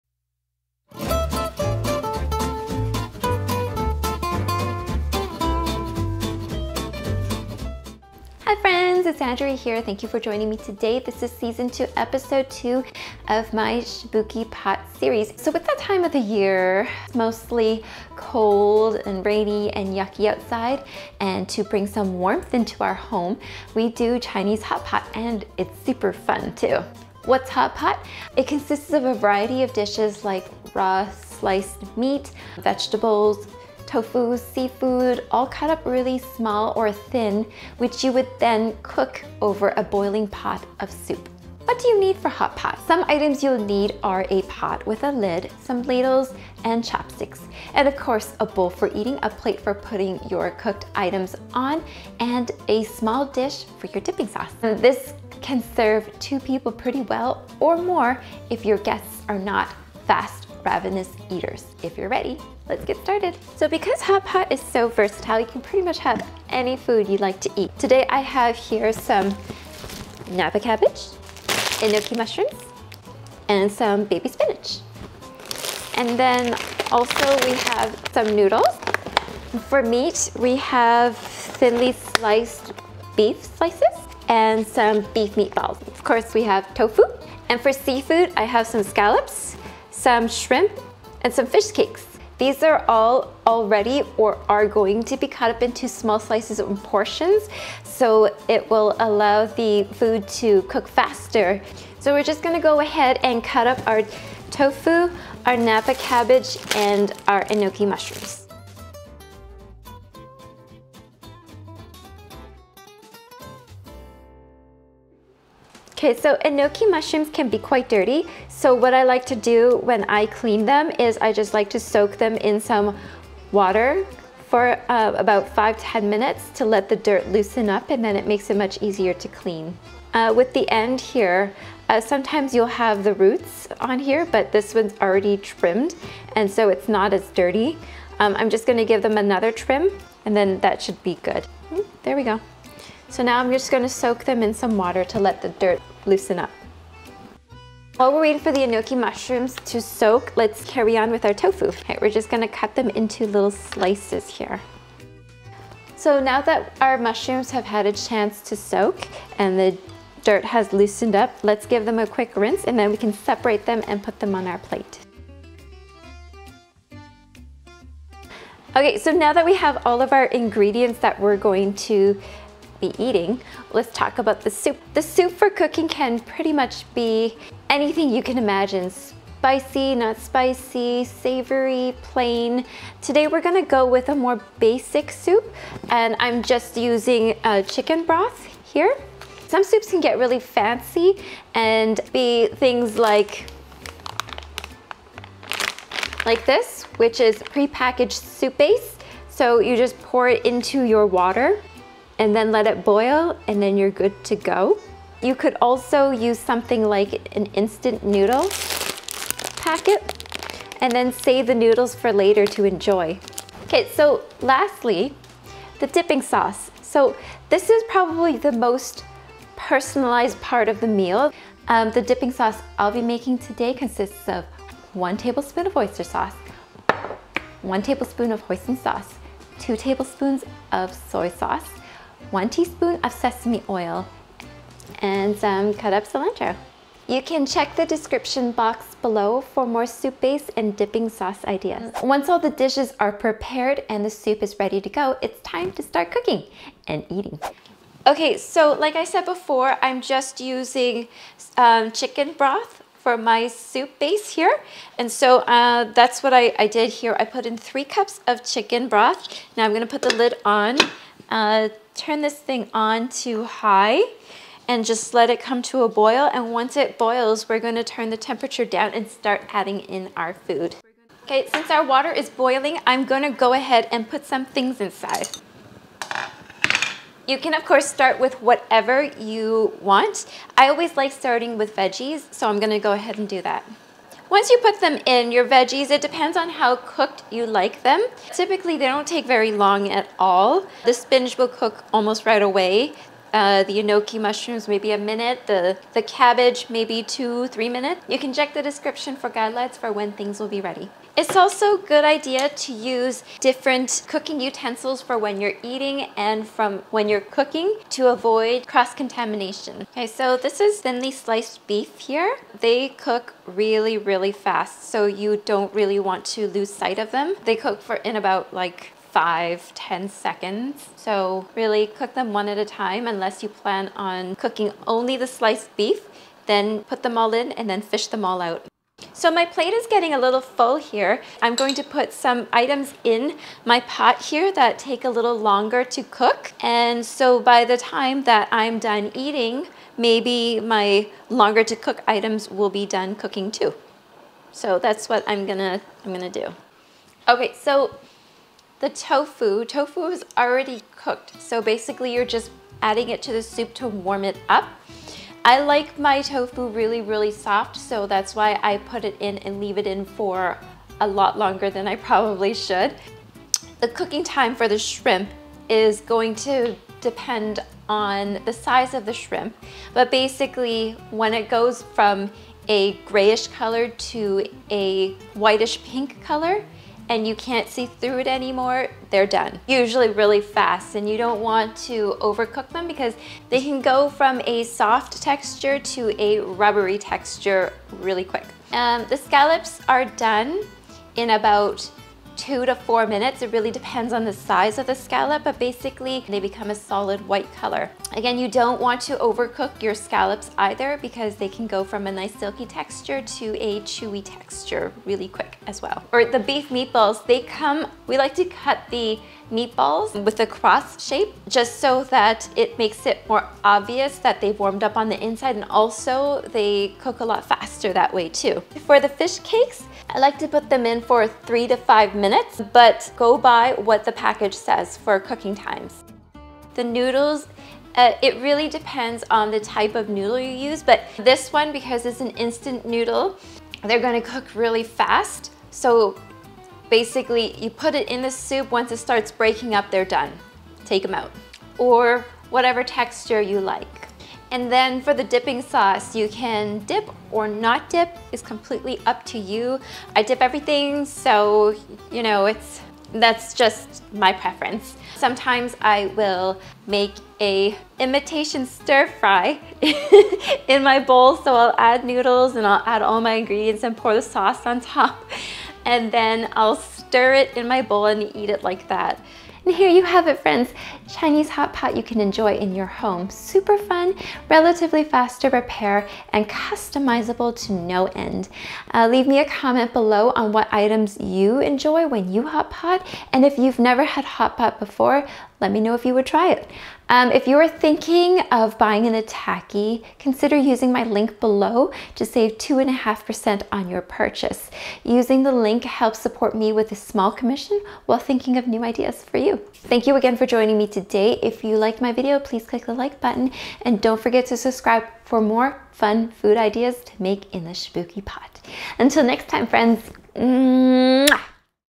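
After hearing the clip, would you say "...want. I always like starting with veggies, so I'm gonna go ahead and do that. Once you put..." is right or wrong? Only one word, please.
right.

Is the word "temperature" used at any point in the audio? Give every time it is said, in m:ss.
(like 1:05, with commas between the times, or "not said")
4:28.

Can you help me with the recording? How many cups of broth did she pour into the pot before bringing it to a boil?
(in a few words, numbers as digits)
3 cups.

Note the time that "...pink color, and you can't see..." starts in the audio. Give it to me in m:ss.
6:15.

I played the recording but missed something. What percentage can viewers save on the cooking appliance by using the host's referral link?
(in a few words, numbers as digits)
2.5%.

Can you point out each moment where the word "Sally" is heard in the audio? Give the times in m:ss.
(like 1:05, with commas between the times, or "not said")
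not said.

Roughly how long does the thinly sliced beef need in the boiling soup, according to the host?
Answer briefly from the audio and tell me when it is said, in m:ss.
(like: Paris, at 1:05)
5 to 10 seconds, at 5:19.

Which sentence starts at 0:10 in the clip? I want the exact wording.
This is season two, episode two of my Shabuki Pot series.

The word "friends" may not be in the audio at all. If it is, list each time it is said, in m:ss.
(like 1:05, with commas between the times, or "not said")
7:50, 8:29.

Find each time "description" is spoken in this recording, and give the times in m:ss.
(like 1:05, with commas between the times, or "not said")
3:57, 4:58.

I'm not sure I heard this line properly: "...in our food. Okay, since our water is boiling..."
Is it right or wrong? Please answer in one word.
right.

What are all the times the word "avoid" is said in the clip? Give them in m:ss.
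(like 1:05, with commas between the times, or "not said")
5:08.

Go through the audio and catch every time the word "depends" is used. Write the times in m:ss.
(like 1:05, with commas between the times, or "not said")
4:46, 6:07, 6:33, 7:08.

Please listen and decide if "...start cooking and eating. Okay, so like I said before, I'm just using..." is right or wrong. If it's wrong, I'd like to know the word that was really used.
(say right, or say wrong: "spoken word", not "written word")
right.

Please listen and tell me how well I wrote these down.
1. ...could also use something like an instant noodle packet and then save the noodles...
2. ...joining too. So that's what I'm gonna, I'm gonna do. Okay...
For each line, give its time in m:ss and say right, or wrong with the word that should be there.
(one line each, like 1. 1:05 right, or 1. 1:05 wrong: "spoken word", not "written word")
1. 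3:25 right
2. 5:43 wrong: "cooking", not "joining".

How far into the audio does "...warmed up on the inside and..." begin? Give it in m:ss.
6:54.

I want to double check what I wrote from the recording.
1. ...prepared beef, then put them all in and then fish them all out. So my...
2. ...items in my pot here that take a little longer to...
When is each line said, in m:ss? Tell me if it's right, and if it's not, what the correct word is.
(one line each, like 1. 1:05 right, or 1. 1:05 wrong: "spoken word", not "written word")
1. 5:25 wrong: "sliced", not "prepared"
2. 5:32 right.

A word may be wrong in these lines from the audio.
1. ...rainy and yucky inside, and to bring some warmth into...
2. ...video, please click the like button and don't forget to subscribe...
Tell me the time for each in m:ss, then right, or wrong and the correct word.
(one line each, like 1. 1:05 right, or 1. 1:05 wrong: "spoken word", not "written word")
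1. 0:19 wrong: "outside", not "inside"
2. 8:22 right.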